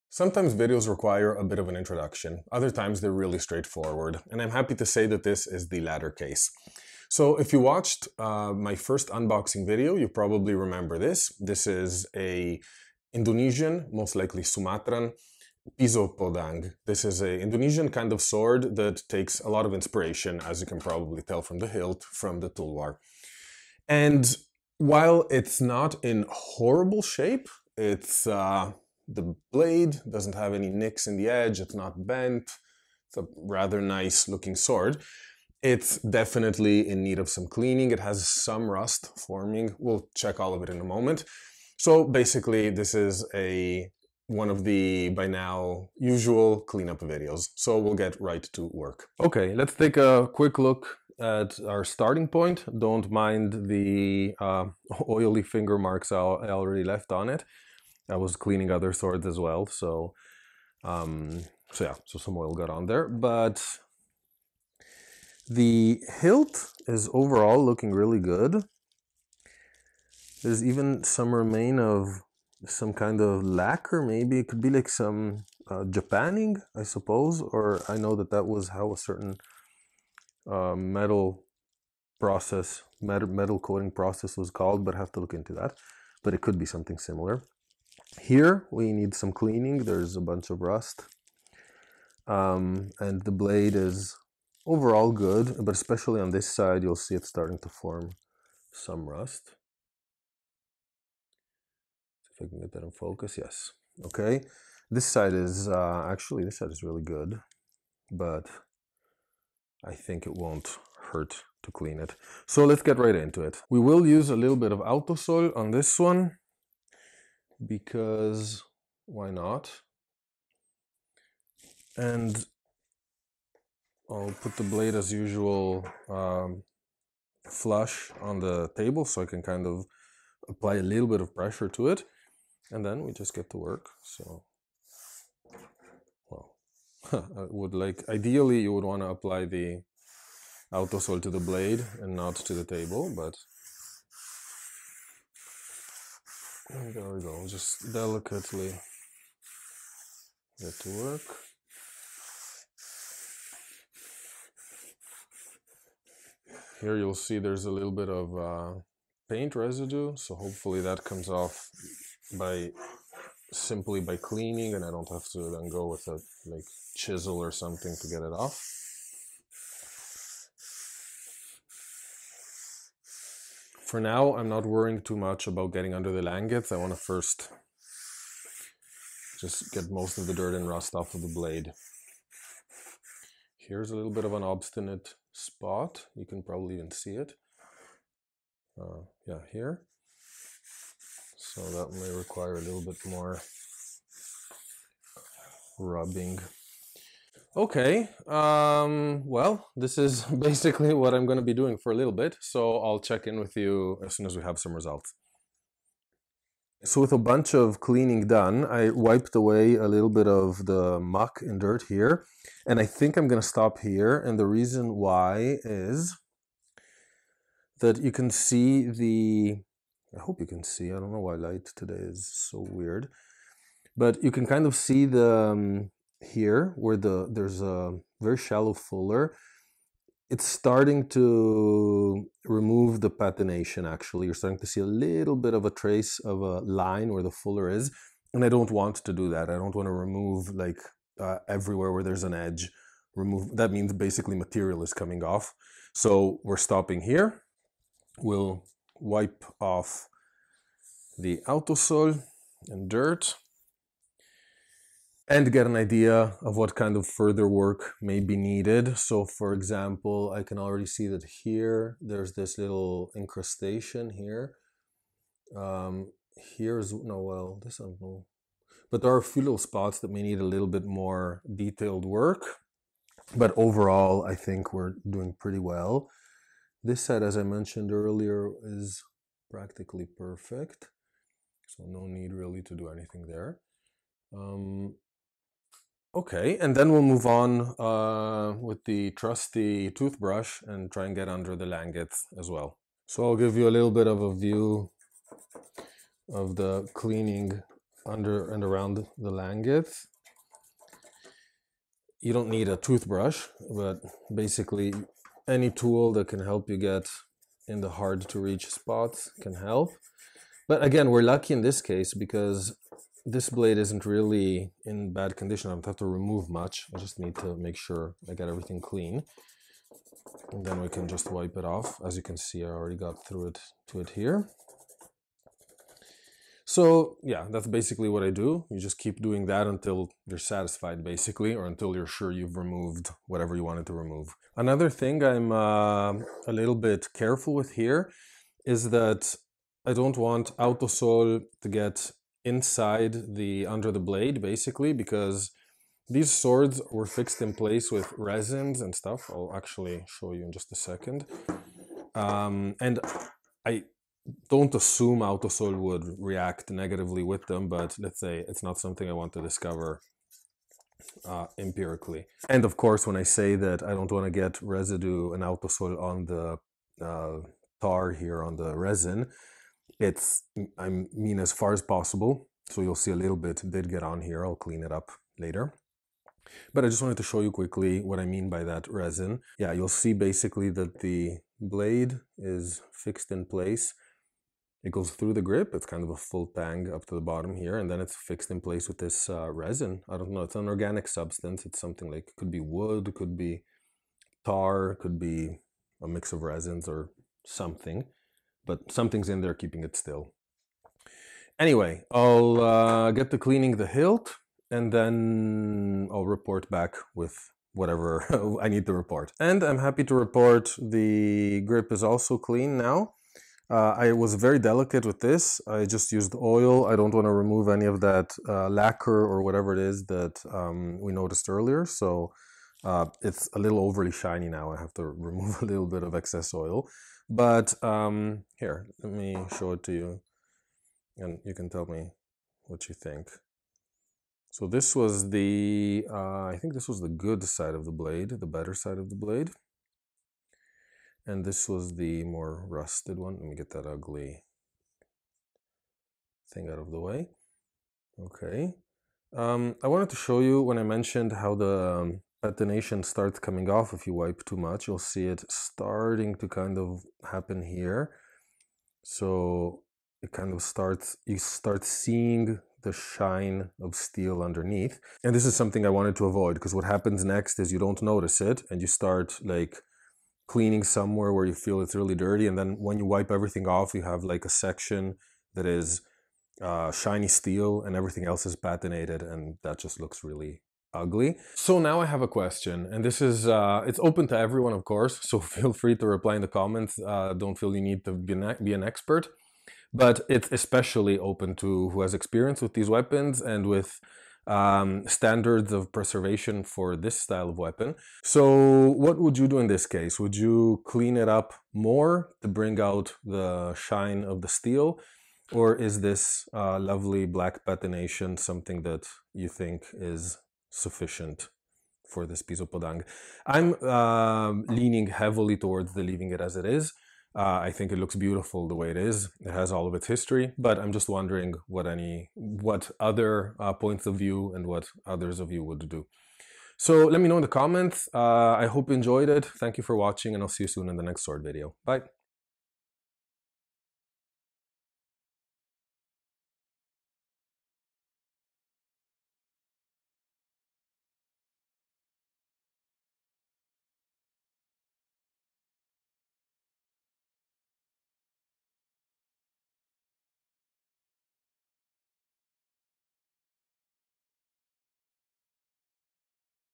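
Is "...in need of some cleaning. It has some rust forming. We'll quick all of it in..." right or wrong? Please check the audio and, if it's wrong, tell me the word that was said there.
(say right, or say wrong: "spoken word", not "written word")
wrong: "check", not "quick".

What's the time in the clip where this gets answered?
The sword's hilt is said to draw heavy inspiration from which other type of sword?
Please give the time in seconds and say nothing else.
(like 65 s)
22 s.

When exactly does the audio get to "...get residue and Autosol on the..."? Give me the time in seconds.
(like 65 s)
364 s.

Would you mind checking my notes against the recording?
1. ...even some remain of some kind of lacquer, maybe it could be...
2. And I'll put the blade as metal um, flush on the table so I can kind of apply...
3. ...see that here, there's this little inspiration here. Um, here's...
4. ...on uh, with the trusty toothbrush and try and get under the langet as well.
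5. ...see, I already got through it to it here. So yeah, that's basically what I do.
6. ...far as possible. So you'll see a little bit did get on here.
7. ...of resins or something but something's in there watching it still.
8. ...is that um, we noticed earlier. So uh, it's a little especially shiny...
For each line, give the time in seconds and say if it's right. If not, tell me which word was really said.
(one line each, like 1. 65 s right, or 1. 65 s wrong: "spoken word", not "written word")
1. 70 s right
2. 121 s wrong: "usual", not "metal"
3. 260 s wrong: "incrustation", not "inspiration"
4. 287 s right
5. 322 s right
6. 371 s right
7. 396 s wrong: "keeping", not "watching"
8. 419 s wrong: "overly", not "especially".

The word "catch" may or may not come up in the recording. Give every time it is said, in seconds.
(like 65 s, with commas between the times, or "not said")
not said.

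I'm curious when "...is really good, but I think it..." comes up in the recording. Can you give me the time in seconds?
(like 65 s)
106 s.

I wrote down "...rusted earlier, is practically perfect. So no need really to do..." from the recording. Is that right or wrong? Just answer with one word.
wrong.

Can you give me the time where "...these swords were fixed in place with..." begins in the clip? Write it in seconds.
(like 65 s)
346 s.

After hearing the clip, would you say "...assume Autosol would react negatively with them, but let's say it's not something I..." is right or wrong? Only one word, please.
right.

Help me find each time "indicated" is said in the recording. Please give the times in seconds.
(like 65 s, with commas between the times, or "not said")
not said.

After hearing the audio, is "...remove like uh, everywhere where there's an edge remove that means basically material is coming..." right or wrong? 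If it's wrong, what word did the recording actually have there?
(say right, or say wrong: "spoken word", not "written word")
right.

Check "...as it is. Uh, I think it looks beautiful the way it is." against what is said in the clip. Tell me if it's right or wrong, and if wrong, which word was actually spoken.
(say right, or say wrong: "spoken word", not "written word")
right.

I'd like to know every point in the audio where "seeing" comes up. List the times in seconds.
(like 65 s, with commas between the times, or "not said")
461 s.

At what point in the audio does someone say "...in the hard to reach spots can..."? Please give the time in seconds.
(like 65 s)
307 s.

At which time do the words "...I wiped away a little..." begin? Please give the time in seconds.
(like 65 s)
208 s.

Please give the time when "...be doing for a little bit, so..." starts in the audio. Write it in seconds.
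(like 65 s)
201 s.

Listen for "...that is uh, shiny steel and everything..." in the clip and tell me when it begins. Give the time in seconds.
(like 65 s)
475 s.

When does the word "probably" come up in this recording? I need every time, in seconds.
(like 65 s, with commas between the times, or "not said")
10 s, 20 s, 186 s.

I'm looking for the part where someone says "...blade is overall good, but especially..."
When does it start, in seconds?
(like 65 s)
93 s.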